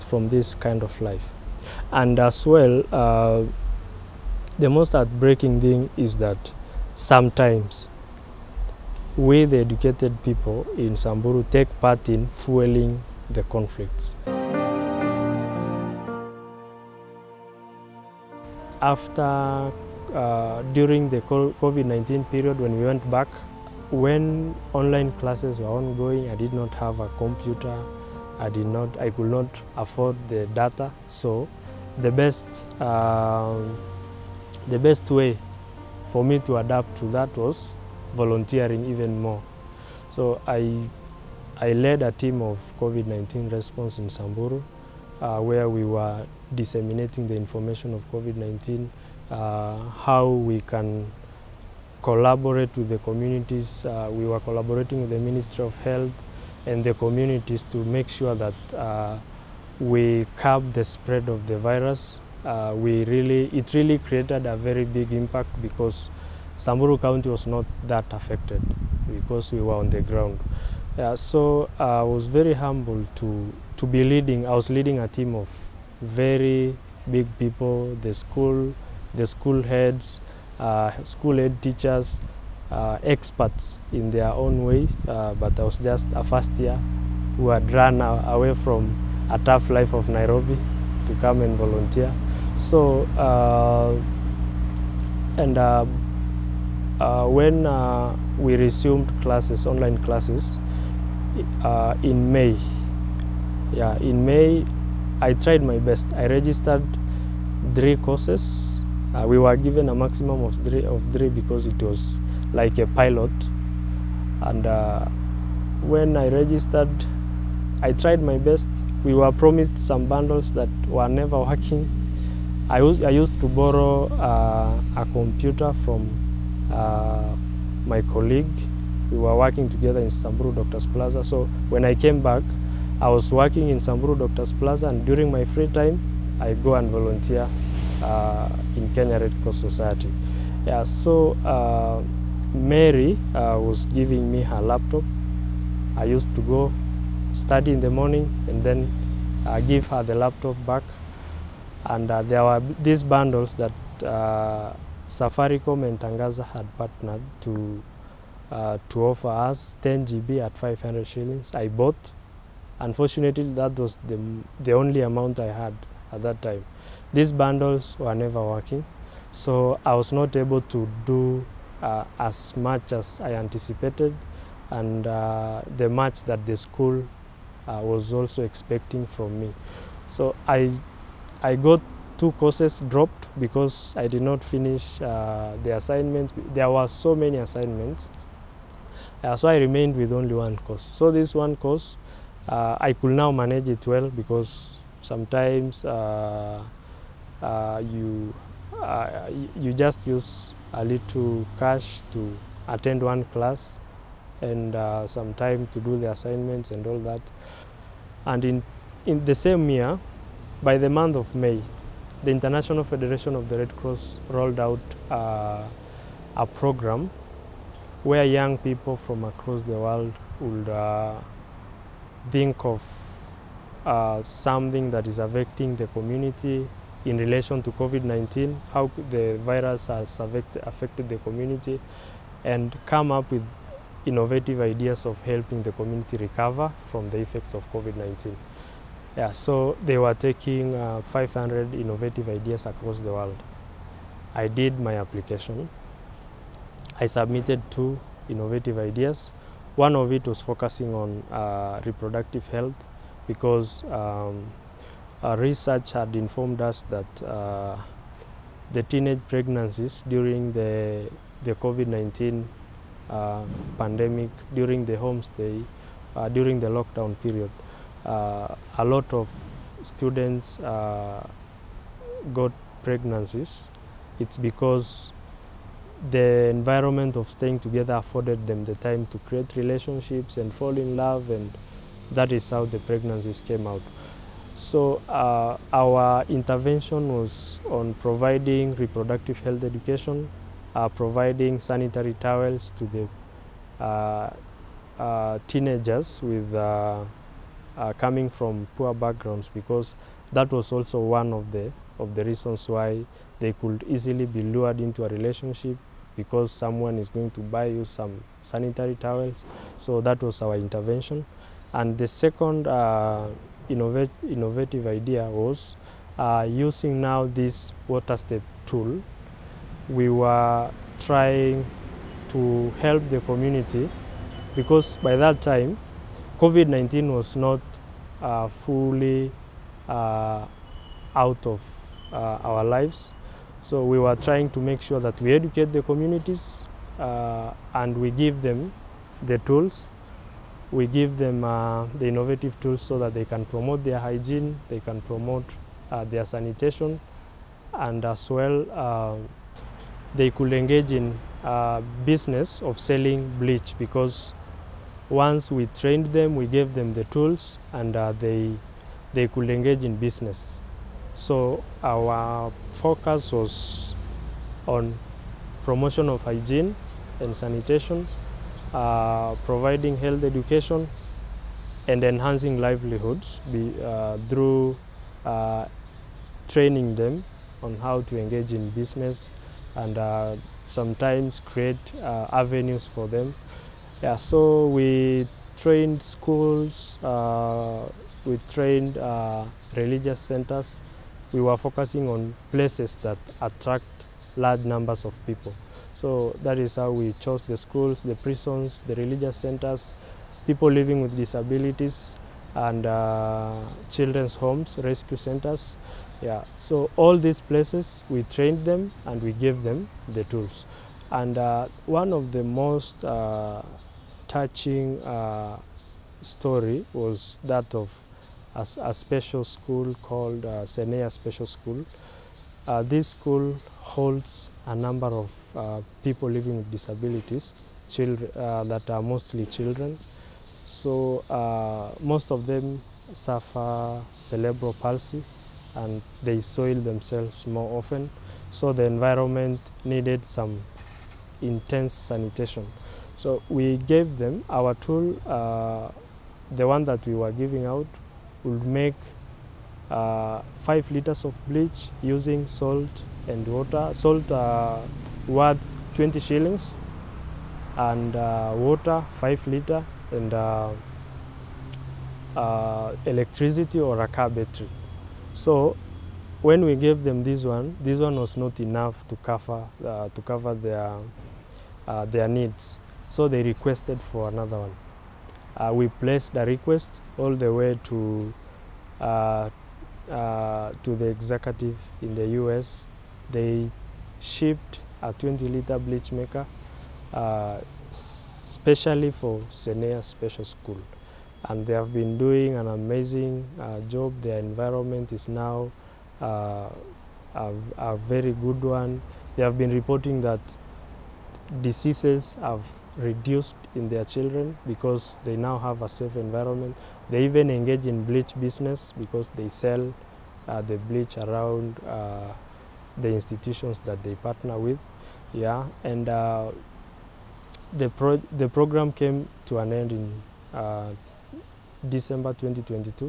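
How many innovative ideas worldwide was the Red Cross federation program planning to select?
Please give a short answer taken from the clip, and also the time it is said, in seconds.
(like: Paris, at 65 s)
500, at 241 s.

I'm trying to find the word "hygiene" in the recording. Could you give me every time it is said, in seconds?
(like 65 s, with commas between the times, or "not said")
343 s, 366 s.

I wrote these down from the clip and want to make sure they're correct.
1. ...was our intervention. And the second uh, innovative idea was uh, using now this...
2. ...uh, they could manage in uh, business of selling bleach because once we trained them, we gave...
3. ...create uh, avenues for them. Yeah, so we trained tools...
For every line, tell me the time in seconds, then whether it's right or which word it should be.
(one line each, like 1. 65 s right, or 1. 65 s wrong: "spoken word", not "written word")
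1. 310 s right
2. 348 s wrong: "engage", not "manage"
3. 381 s wrong: "schools", not "tools".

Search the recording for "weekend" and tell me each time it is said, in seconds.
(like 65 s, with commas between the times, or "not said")
not said.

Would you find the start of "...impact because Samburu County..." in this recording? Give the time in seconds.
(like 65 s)
65 s.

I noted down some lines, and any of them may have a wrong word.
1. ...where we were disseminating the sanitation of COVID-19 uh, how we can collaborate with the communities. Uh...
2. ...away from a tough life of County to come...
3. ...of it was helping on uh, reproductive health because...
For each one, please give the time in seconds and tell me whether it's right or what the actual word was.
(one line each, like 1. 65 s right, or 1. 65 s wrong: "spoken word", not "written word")
1. 45 s wrong: "information", not "sanitation"
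2. 88 s wrong: "Nairobi", not "County"
3. 249 s wrong: "focusing", not "helping".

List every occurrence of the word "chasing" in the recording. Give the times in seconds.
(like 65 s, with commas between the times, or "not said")
not said.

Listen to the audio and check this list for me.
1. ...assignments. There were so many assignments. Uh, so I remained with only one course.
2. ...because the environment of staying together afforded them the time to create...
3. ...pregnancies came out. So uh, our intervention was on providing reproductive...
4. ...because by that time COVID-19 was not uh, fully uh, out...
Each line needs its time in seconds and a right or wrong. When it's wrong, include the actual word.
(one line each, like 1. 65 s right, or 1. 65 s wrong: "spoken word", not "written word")
1. 185 s right
2. 274 s right
3. 282 s right
4. 324 s right.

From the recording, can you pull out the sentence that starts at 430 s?
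So uh, most of them suffer cerebral palsy and they soil themselves more often.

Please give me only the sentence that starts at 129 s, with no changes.
We were working together in Samburu Doctors Plaza.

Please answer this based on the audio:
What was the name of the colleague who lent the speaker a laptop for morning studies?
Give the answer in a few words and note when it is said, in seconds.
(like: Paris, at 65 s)
Mary, at 142 s.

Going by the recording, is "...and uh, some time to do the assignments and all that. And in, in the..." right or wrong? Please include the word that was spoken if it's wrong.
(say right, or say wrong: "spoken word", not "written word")
right.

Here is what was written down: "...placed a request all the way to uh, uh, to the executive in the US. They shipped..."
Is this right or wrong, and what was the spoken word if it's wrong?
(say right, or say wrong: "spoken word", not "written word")
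right.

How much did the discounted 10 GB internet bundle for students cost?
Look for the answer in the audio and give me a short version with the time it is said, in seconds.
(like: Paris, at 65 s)
500 shillings, at 160 s.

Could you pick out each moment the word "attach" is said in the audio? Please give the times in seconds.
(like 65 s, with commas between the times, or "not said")
not said.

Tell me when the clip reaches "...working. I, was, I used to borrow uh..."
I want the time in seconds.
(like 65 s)
121 s.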